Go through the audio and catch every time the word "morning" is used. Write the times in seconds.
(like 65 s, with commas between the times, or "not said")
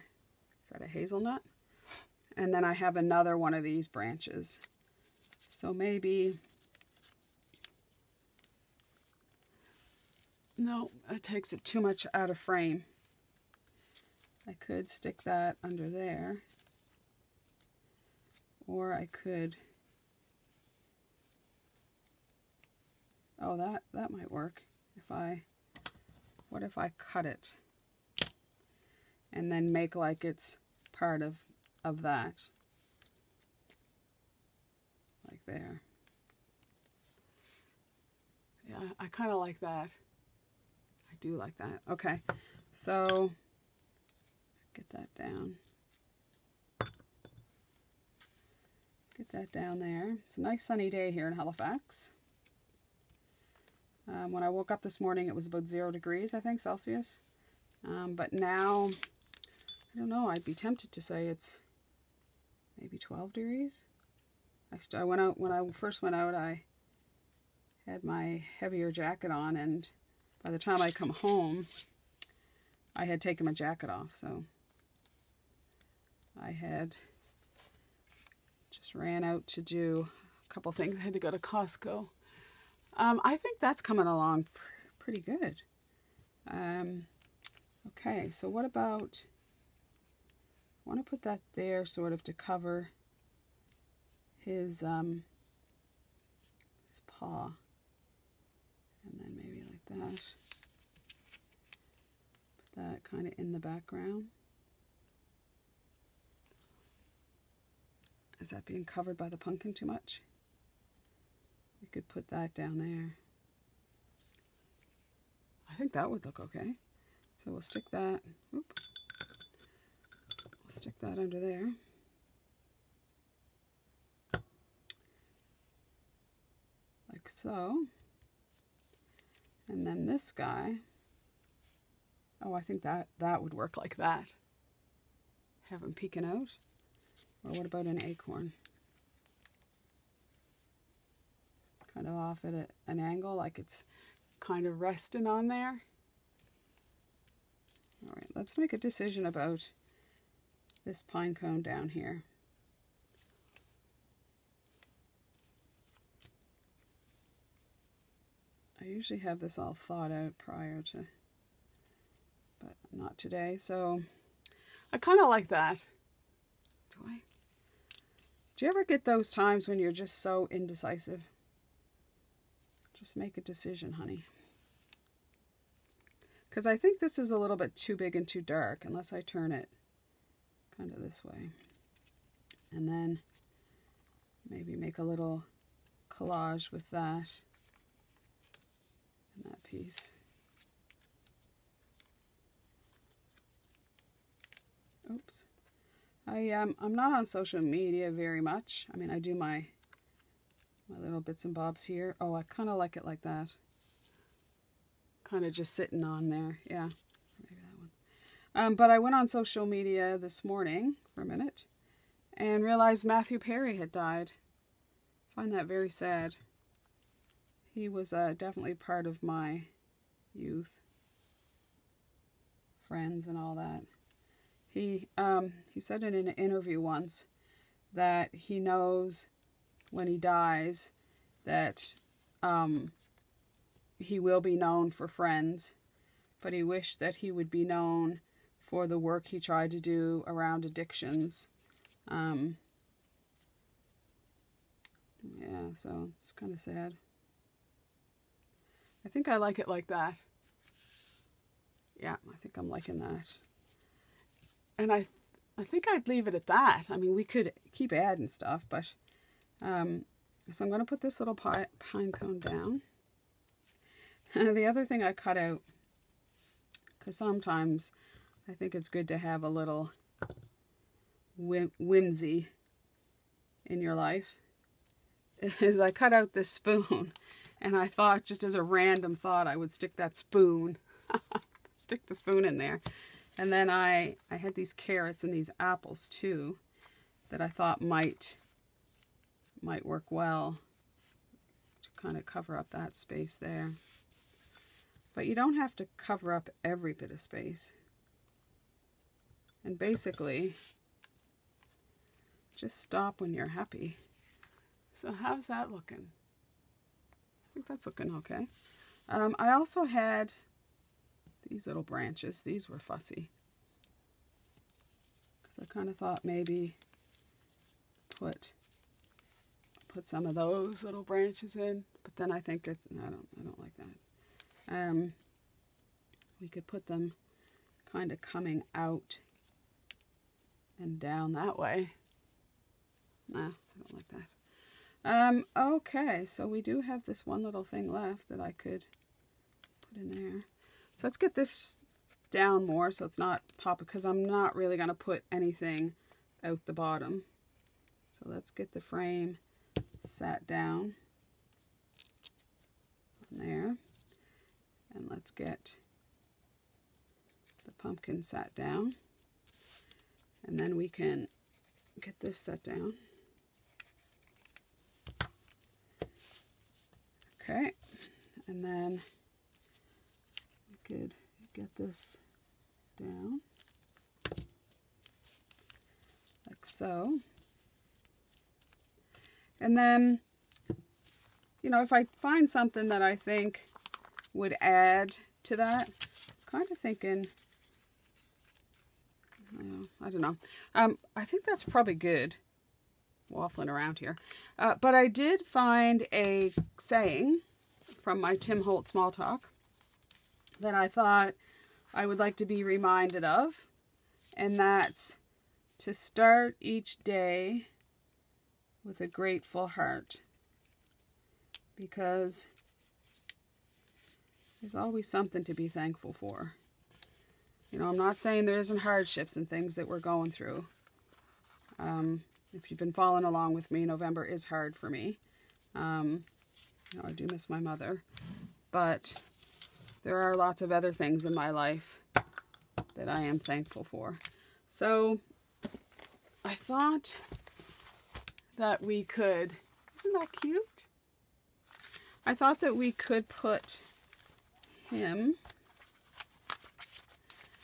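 54 s, 210 s.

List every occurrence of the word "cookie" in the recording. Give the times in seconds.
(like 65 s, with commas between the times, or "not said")
not said.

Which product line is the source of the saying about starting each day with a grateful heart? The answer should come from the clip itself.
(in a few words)
Tim Holtz Small Talk.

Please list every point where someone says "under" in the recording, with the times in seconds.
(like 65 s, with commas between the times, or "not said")
15 s, 121 s.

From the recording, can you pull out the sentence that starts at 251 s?
Yeah, I think I'm liking that and I, I think I'd leave it at that.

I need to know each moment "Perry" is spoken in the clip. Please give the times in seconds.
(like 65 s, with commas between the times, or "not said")
213 s.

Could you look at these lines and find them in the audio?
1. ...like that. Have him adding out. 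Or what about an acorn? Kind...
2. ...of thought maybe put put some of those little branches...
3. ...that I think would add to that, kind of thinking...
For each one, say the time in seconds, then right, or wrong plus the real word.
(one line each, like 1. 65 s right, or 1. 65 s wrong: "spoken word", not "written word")
1. 133 s wrong: "peeking", not "adding"
2. 315 s right
3. 382 s right.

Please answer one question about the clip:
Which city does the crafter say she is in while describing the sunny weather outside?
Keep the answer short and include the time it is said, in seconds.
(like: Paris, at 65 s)
Halifax, at 51 s.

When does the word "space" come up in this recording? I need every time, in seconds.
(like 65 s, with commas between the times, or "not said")
292 s, 297 s.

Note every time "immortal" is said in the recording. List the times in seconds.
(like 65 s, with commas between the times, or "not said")
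not said.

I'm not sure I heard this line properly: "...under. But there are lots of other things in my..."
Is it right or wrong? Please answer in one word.
wrong.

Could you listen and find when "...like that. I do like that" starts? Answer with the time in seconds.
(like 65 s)
39 s.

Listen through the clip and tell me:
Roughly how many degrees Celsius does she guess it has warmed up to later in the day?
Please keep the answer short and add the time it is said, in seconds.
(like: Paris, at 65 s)
12, at 62 s.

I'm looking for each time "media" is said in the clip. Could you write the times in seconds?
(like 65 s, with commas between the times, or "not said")
197 s, 209 s.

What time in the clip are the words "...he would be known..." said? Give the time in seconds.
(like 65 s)
237 s.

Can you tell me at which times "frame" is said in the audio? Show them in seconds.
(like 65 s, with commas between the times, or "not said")
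12 s, 348 s.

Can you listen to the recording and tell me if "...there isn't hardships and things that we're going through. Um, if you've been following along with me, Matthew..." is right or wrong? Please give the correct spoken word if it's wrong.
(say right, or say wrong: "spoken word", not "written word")
wrong: "November", not "Matthew".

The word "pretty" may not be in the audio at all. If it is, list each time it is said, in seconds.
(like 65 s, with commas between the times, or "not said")
84 s.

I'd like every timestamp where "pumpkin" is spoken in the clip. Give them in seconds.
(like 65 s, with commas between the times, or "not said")
109 s, 357 s.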